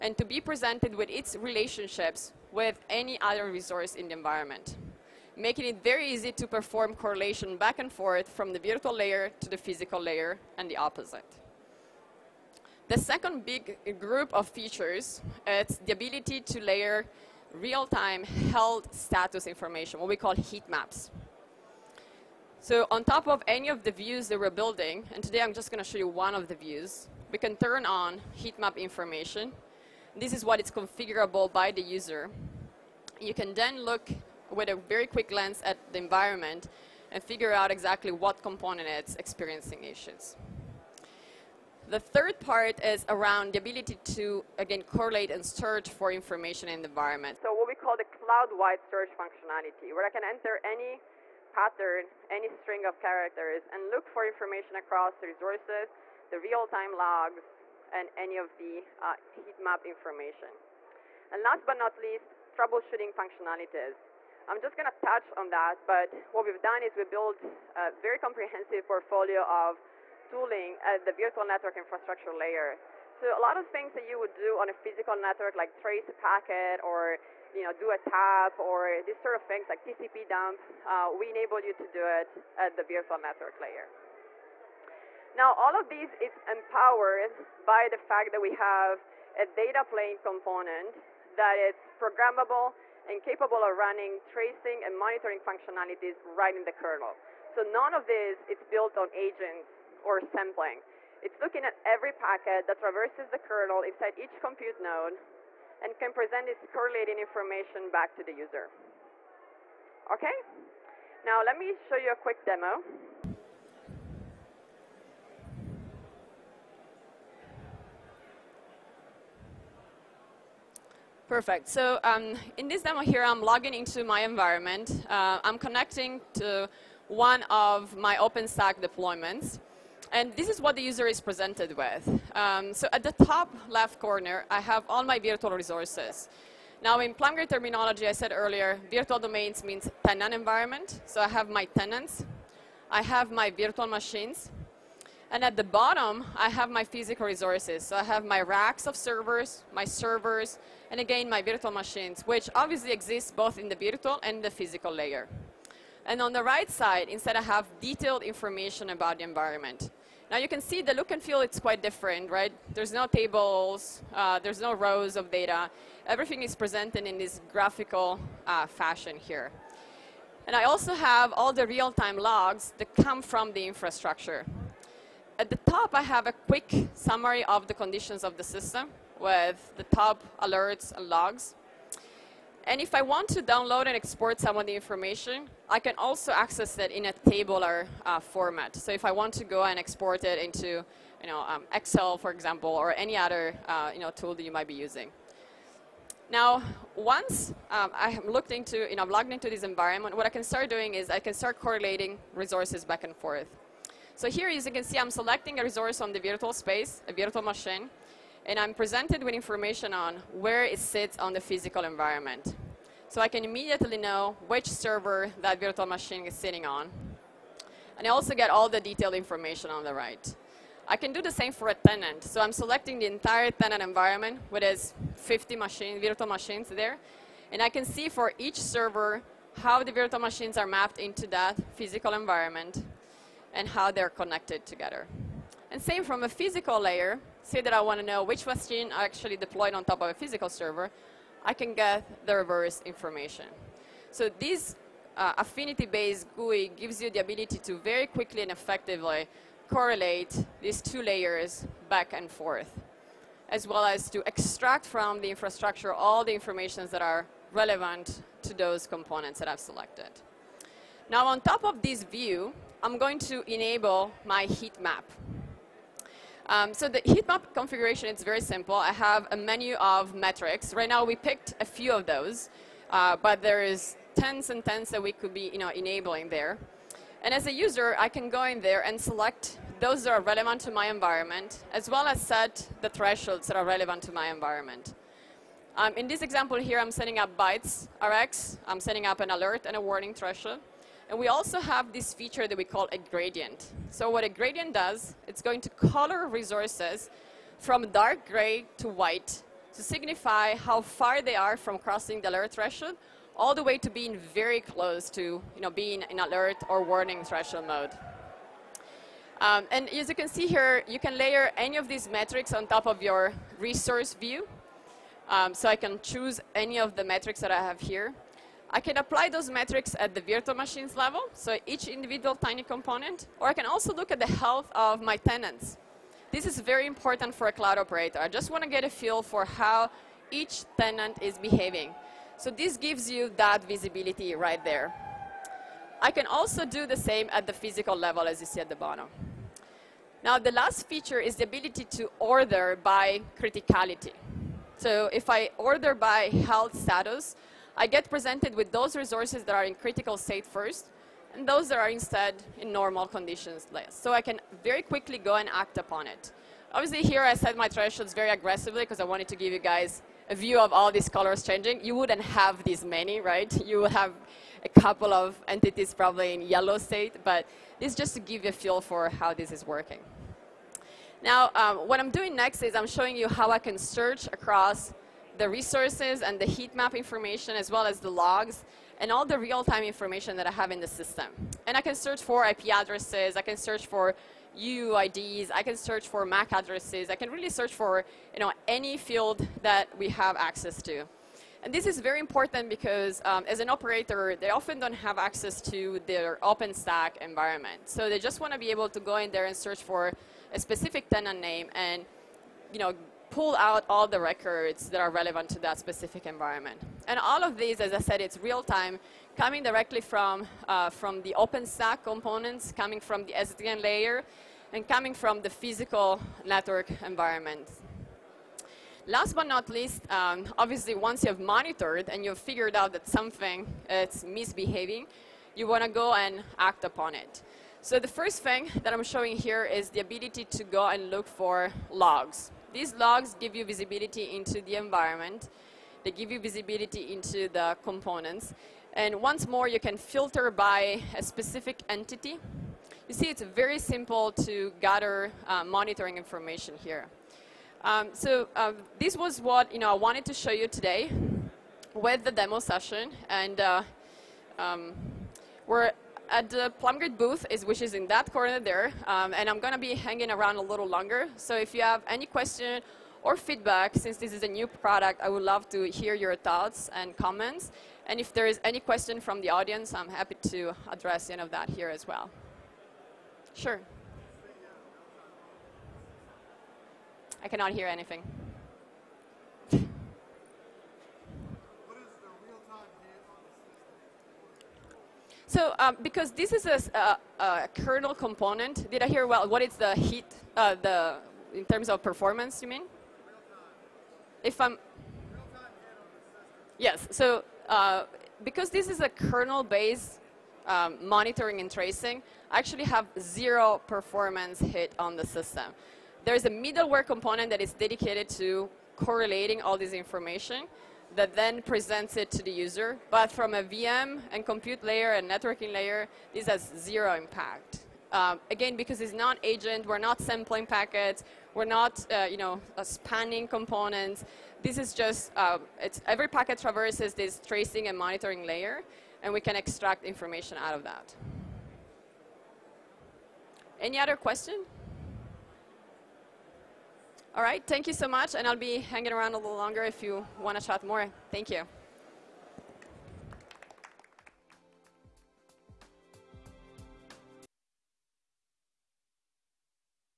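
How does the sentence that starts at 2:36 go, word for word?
And on the right side, instead I have detailed information about the environment.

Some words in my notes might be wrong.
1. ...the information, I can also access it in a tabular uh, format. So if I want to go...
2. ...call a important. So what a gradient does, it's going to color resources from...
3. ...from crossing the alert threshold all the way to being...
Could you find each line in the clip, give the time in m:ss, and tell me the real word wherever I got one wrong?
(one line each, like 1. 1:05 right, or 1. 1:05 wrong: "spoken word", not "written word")
1. 3:04 right
2. 4:52 wrong: "gradient", not "important"
3. 5:01 right.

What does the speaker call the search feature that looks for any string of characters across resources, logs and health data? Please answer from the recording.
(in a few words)
Cloud-wide search.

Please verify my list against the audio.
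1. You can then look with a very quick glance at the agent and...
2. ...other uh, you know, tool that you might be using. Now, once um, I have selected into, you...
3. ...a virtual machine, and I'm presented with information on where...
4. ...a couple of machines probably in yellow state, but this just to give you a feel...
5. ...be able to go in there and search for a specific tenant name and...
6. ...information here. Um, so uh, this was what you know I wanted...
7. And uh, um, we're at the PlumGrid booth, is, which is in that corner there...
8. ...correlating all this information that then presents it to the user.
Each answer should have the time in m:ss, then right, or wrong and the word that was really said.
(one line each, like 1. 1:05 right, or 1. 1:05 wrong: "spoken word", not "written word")
1. 0:33 wrong: "environment", not "agent"
2. 3:13 wrong: "looked", not "selected"
3. 3:27 right
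4. 6:04 wrong: "entities", not "machines"
5. 6:38 right
6. 7:26 right
7. 7:33 right
8. 8:28 right.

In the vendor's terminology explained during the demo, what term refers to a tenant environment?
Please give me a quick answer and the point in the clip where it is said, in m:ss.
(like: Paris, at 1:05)
Virtual domains, at 2:18.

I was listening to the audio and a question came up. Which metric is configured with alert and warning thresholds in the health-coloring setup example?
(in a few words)
Bytes RX.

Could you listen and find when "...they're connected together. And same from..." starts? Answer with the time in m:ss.
3:53.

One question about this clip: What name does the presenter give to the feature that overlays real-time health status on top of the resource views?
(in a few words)
Heat maps.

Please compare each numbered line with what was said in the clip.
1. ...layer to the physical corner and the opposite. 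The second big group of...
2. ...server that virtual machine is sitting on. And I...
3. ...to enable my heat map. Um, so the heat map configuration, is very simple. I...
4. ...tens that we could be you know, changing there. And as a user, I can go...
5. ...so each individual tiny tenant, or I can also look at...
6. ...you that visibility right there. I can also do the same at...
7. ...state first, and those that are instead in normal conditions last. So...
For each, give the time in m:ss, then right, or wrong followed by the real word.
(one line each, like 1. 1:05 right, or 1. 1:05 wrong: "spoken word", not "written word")
1. 0:08 wrong: "layer", not "corner"
2. 3:34 right
3. 4:23 right
4. 4:34 wrong: "enabling", not "changing"
5. 5:21 wrong: "component", not "tenant"
6. 5:33 right
7. 5:50 right.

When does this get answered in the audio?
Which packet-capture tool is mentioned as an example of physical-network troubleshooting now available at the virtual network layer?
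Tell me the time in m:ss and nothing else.
1:19.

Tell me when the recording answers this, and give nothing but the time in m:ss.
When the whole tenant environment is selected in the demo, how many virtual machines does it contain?
3:45.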